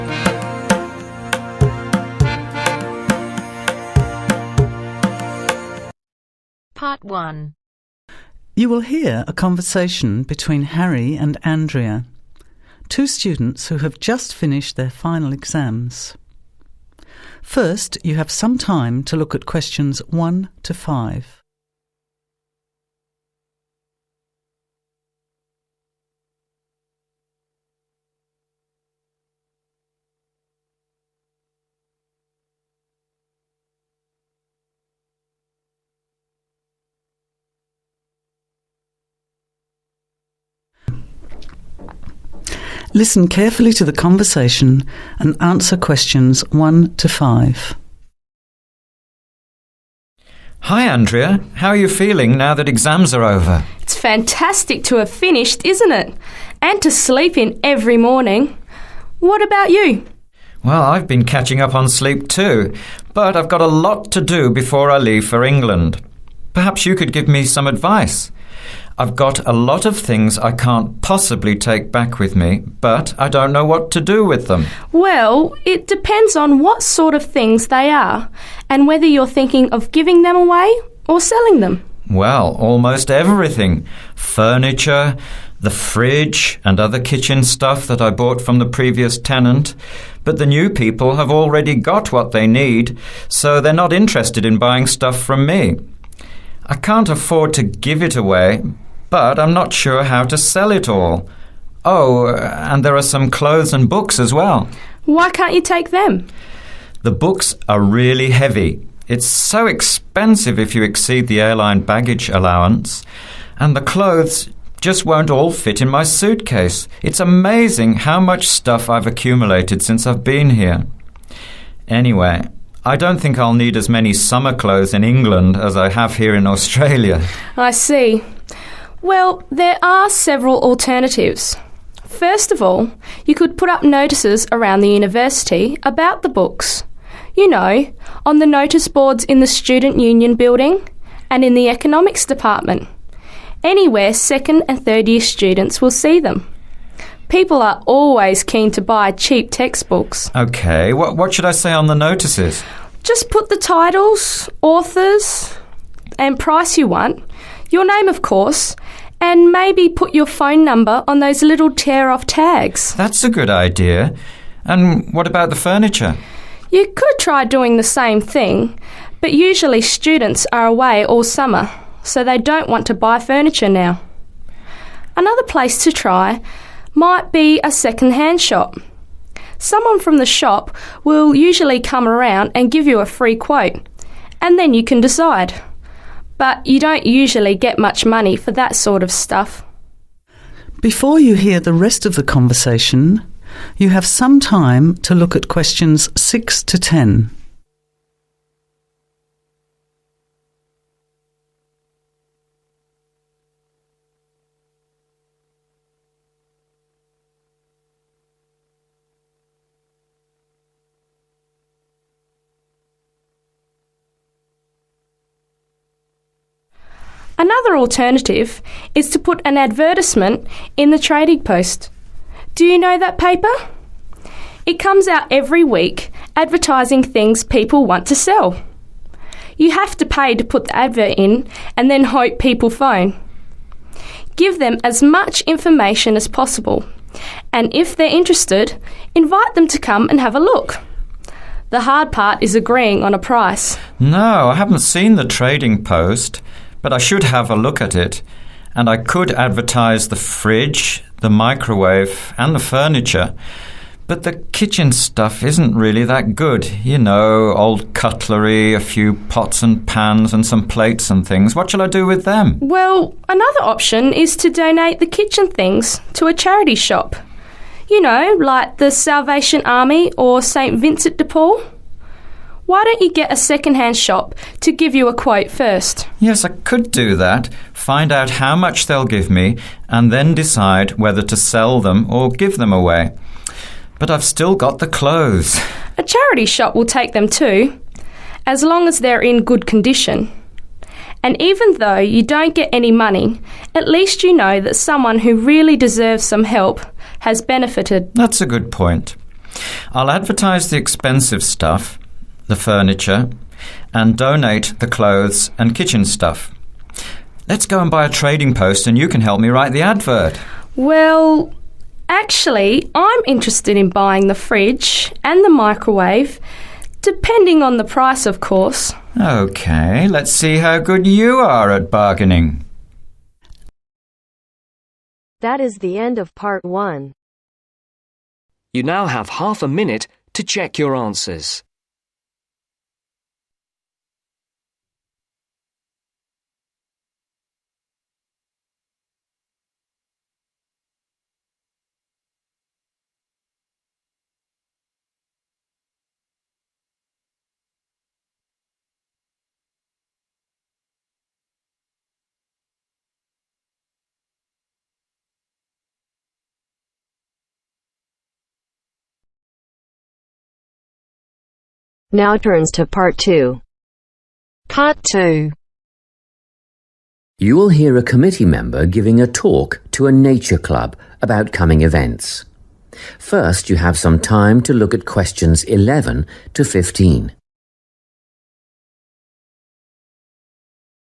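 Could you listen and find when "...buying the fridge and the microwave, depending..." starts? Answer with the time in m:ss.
5:13.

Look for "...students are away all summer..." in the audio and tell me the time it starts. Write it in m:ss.
2:49.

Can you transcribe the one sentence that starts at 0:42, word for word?
Listen carefully to the conversation and answer questions 1 to 5.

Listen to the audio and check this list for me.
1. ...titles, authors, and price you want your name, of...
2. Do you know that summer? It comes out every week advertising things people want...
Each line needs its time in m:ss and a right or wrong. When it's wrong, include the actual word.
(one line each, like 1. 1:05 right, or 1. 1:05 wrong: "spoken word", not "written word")
1. 2:33 right
2. 3:42 wrong: "paper", not "summer".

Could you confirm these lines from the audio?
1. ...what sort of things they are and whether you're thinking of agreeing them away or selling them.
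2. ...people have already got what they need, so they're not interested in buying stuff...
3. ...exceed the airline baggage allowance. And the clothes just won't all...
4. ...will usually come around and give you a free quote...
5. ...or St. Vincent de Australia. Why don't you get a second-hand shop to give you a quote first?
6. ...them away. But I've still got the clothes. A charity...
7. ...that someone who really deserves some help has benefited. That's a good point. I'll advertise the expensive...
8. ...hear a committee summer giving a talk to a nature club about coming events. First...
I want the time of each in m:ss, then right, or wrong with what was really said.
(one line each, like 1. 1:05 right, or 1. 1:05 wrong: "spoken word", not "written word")
1. 1:16 wrong: "giving", not "agreeing"
2. 1:30 right
3. 1:50 right
4. 3:01 right
5. 4:30 wrong: "Paul", not "Australia"
6. 4:42 right
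7. 4:54 right
8. 6:07 wrong: "member", not "summer".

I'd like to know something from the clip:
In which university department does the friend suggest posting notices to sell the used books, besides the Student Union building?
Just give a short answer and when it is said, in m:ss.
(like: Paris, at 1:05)
Economics department, at 2:21.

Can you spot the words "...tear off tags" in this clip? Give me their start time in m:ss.
2:41.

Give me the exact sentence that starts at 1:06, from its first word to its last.
Perhaps you could give me some advice.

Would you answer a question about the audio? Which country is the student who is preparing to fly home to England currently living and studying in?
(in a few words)
Australia.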